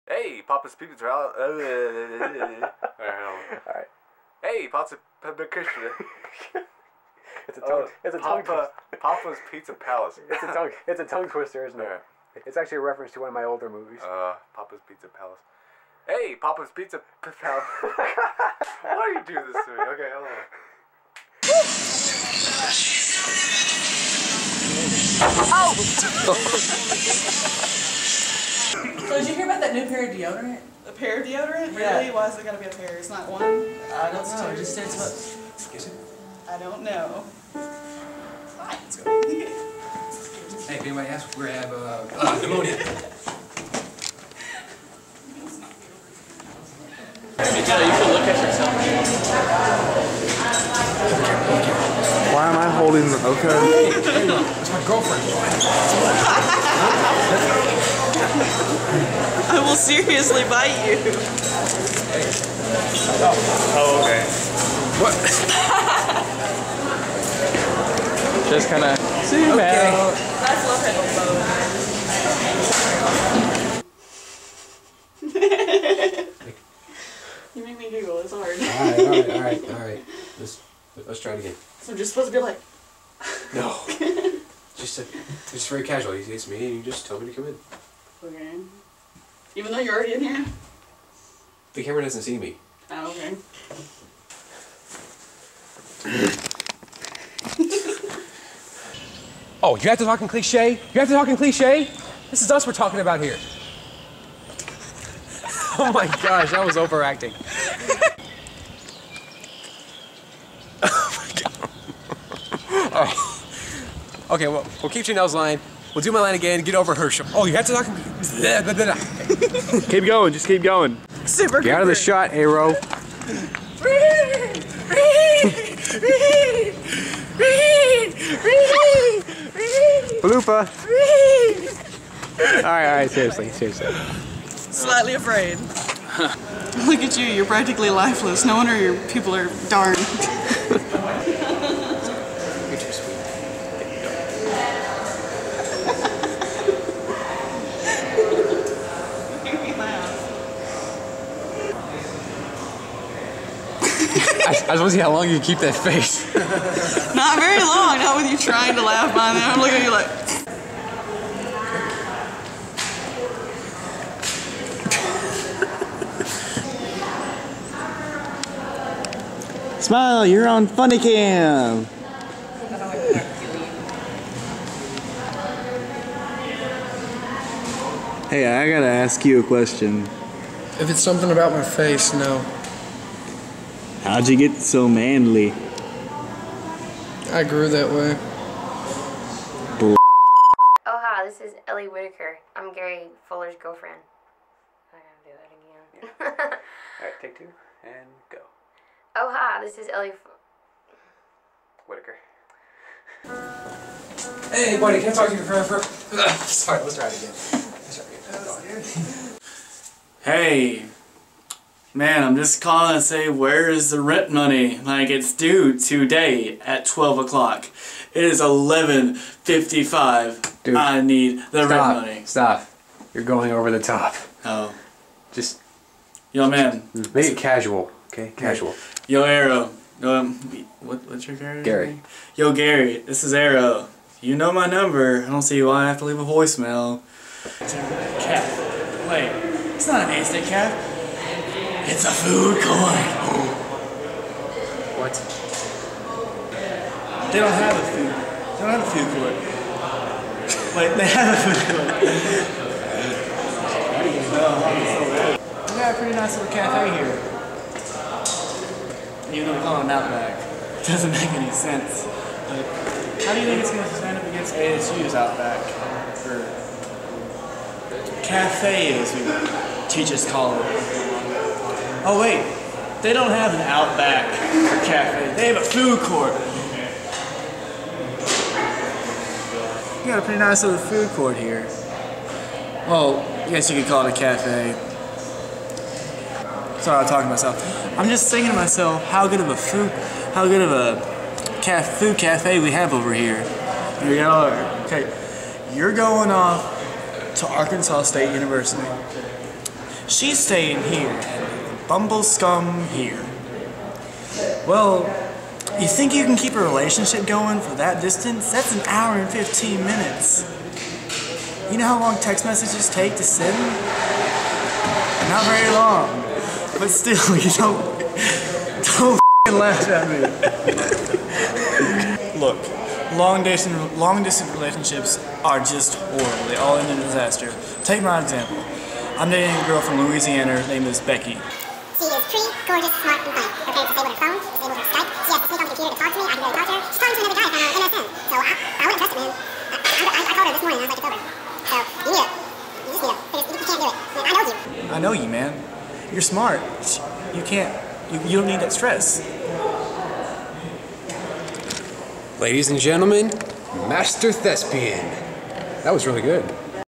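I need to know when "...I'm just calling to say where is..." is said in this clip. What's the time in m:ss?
3:32.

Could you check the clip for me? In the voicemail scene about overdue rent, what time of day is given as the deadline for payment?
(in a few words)
12 o'clock.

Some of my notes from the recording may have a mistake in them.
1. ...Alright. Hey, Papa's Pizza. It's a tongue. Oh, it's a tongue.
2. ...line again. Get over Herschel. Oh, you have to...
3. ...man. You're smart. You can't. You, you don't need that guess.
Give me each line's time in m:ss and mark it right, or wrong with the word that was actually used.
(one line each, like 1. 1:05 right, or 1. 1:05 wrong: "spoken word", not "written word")
1. 0:01 right
2. 1:56 right
3. 5:45 wrong: "stress", not "guess".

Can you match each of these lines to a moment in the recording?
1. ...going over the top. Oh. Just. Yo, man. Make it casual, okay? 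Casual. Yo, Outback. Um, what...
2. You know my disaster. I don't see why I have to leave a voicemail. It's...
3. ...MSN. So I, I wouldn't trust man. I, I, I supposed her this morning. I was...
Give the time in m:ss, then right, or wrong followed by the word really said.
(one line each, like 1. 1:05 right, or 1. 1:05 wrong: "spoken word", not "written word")
1. 3:43 wrong: "Arrow", not "Outback"
2. 3:54 wrong: "number", not "disaster"
3. 5:37 wrong: "called", not "supposed".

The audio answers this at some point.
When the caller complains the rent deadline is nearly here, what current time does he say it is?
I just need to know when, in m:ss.
3:38.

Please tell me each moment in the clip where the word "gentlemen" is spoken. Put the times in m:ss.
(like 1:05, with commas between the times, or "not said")
5:52.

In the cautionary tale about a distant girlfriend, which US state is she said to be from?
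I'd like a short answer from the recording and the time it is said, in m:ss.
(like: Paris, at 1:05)
Louisiana, at 5:30.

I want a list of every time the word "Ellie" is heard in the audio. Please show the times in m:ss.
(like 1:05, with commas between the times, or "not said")
3:11, 3:19.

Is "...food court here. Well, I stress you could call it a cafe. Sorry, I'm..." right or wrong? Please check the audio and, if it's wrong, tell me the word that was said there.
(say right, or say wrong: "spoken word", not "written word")
wrong: "guess", not "stress".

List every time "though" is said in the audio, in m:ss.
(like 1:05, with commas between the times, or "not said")
1:29, 4:19.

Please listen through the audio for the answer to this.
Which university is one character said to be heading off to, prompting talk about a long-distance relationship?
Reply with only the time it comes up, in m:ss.
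4:57.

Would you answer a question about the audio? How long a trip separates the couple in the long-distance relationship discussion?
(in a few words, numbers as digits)
an hour and 15 minutes.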